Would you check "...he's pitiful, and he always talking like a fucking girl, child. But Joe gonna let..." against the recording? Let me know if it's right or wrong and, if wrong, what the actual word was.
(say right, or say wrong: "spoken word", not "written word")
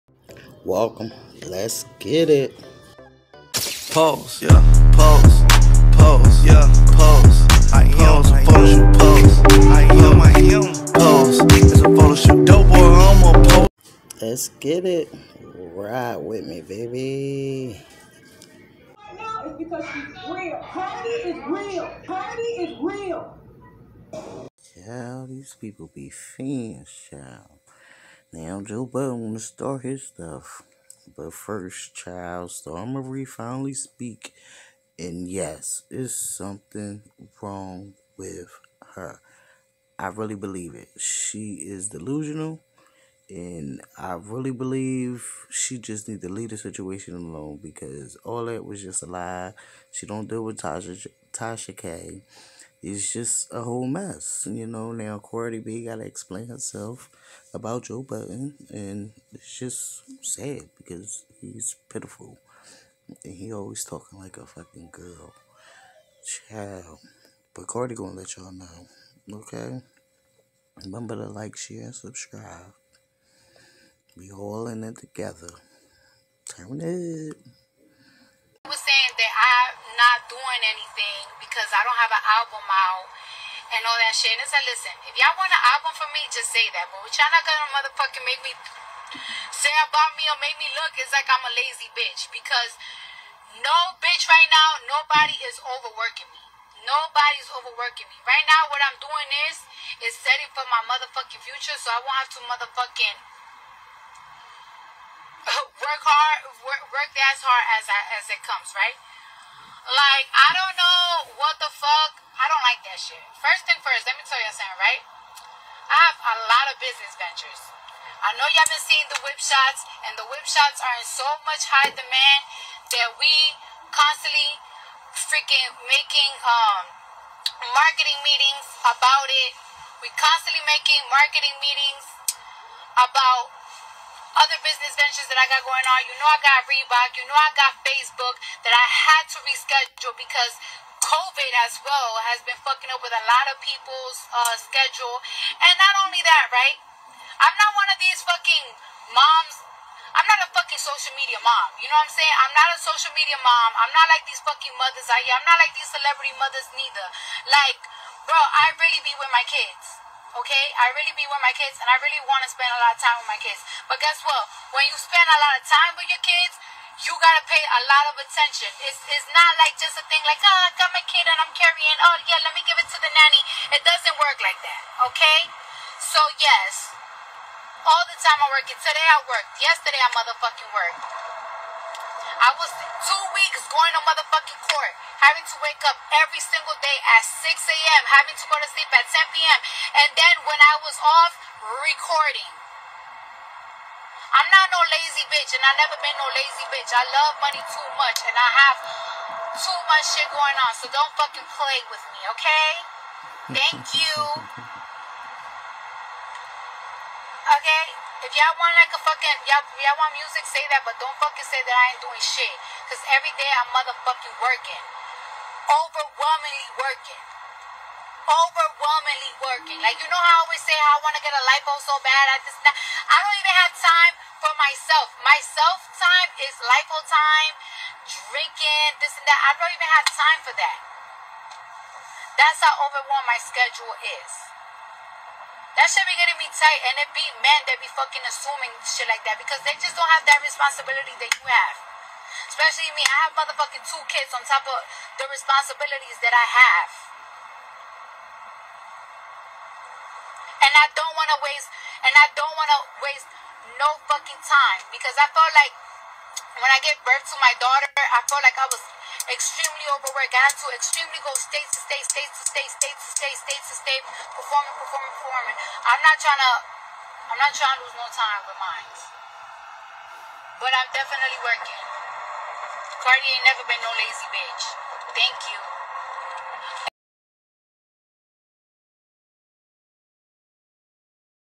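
wrong: "Cardi", not "Joe".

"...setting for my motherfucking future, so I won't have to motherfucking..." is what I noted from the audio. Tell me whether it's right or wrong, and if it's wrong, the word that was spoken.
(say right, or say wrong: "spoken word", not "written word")
right.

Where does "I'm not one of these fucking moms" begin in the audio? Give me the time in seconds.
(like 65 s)
147 s.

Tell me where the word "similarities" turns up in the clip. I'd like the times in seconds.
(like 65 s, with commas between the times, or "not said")
not said.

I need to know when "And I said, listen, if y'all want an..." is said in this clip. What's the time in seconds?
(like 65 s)
84 s.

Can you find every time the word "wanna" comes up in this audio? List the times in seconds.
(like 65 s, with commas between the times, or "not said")
29 s, 221 s.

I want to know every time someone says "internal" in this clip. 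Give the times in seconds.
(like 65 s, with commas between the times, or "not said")
not said.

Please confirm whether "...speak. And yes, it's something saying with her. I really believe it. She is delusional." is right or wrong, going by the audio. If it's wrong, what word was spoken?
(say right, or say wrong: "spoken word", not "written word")
wrong: "wrong", not "saying".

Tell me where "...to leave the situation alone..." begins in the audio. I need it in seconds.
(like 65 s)
46 s.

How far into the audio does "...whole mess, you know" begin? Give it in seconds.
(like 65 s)
53 s.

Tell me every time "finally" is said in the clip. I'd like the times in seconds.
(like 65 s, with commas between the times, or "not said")
33 s.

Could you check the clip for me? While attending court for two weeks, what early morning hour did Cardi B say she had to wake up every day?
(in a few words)
6 a.m.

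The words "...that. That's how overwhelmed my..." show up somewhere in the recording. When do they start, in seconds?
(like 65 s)
230 s.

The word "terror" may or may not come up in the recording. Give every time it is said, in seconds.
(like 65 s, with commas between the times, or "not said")
not said.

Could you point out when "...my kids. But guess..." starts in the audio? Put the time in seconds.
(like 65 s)
163 s.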